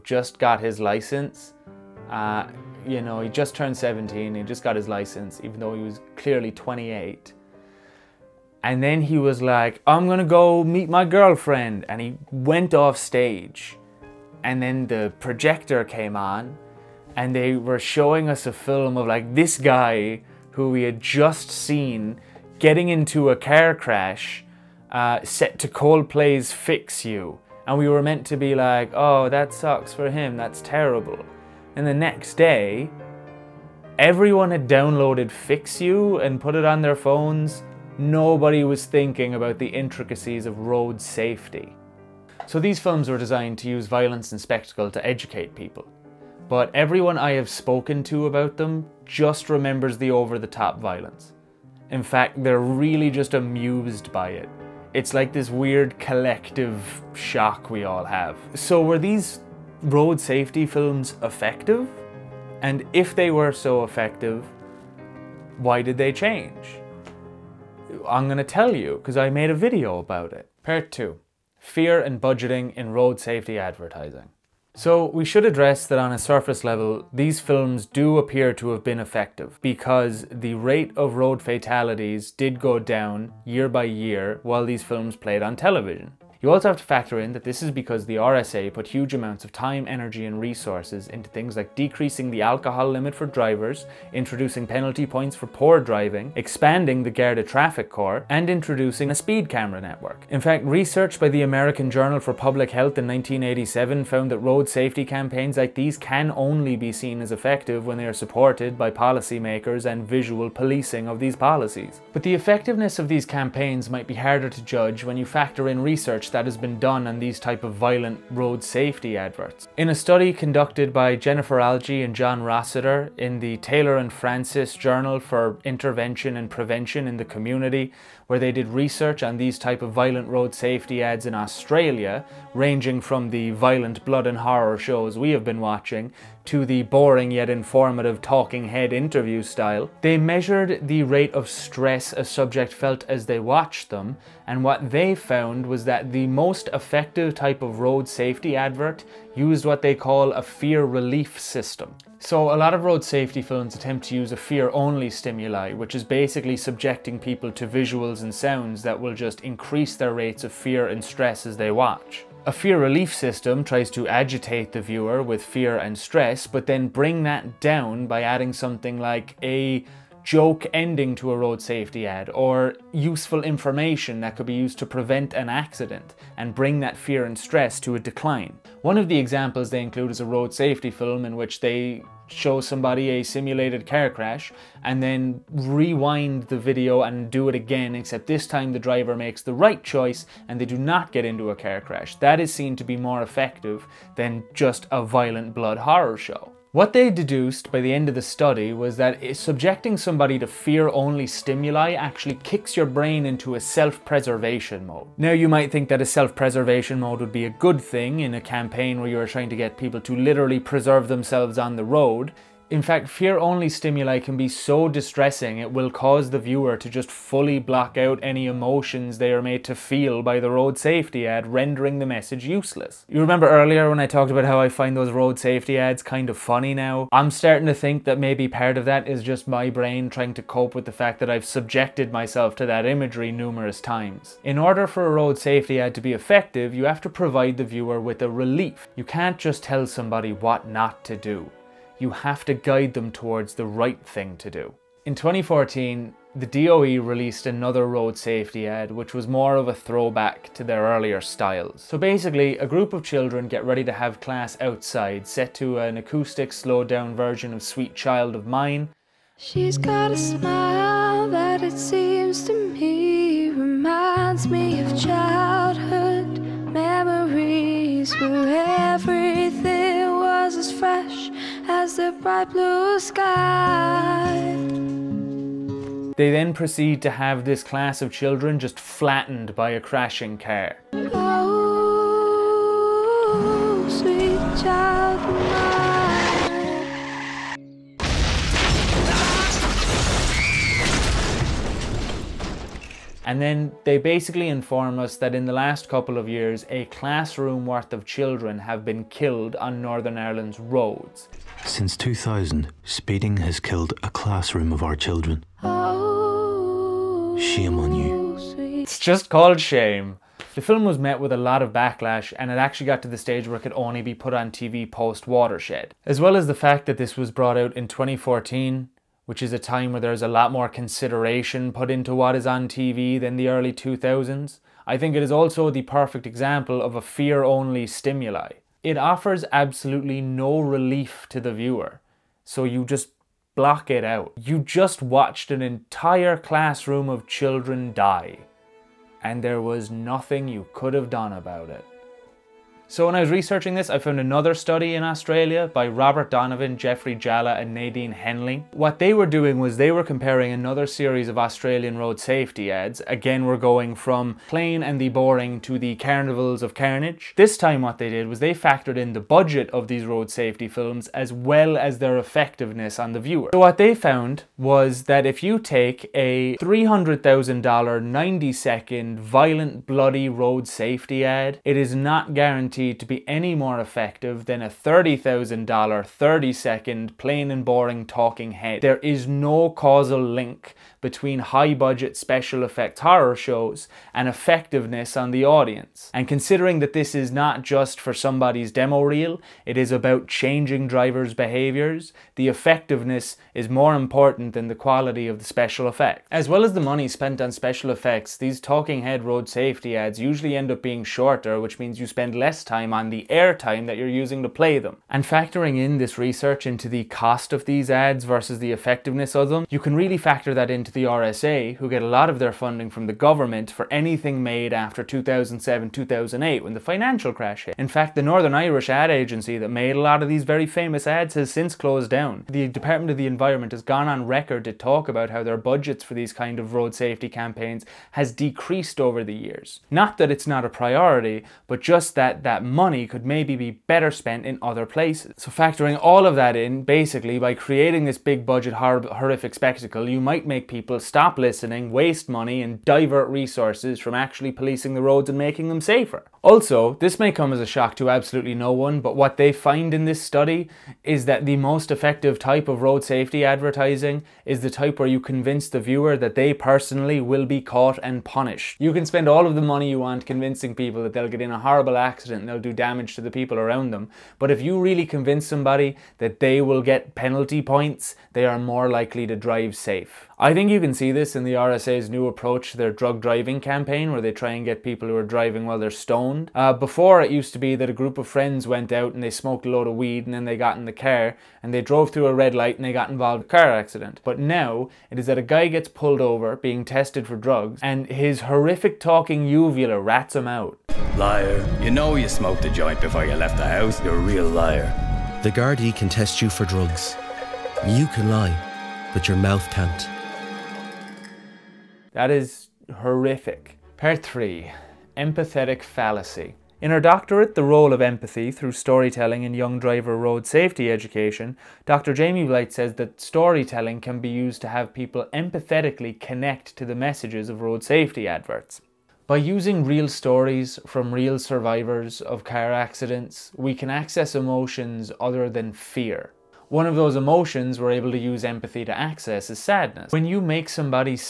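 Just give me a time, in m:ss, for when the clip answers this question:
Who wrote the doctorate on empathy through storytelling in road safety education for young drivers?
8:31.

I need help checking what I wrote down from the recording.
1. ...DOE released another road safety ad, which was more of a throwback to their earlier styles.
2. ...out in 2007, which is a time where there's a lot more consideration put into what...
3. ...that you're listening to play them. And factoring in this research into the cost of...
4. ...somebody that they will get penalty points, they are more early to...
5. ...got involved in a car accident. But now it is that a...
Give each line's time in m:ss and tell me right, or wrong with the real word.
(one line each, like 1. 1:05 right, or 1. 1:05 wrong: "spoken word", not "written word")
1. 4:06 right
2. 5:17 wrong: "2014", not "2007"
3. 6:43 wrong: "using", not "listening"
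4. 7:45 wrong: "likely", not "early"
5. 8:02 right.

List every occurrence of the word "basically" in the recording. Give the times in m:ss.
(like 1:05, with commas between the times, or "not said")
2:36, 4:11, 4:53, 7:16.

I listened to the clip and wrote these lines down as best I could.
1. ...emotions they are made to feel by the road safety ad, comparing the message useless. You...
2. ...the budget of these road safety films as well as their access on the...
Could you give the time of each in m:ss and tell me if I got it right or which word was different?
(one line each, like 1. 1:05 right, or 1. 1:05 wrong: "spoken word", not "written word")
1. 3:38 wrong: "rendering", not "comparing"
2. 5:59 wrong: "effectiveness", not "access".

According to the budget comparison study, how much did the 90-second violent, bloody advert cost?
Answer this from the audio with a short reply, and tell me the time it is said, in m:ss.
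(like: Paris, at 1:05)
$300,000, at 6:06.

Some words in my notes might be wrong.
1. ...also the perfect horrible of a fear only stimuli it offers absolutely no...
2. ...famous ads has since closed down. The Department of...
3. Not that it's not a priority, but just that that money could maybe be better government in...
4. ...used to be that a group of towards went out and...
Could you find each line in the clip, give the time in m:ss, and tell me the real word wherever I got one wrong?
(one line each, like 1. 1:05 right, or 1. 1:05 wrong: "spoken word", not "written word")
1. 5:25 wrong: "example", not "horrible"
2. 7:00 right
3. 7:09 wrong: "spent", not "government"
4. 7:57 wrong: "friends", not "towards".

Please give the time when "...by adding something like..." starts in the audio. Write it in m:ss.
2:48.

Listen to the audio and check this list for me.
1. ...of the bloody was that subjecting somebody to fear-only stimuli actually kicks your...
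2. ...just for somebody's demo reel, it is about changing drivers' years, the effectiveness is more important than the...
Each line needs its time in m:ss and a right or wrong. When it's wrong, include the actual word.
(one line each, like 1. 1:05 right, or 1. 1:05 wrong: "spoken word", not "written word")
1. 3:18 wrong: "study", not "bloody"
2. 6:27 wrong: "behaviors", not "years".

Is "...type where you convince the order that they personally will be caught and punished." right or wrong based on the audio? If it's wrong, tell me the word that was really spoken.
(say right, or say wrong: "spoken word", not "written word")
wrong: "viewer", not "order".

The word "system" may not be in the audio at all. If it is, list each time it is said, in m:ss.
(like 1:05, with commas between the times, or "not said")
2:31, 2:43.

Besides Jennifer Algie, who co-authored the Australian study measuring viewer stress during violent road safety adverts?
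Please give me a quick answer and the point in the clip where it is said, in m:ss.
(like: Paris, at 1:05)
John Rossiter, at 2:02.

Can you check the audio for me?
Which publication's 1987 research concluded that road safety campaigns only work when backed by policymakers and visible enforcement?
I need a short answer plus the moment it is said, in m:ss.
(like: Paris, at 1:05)
American Journal for Public Health, at 1:41.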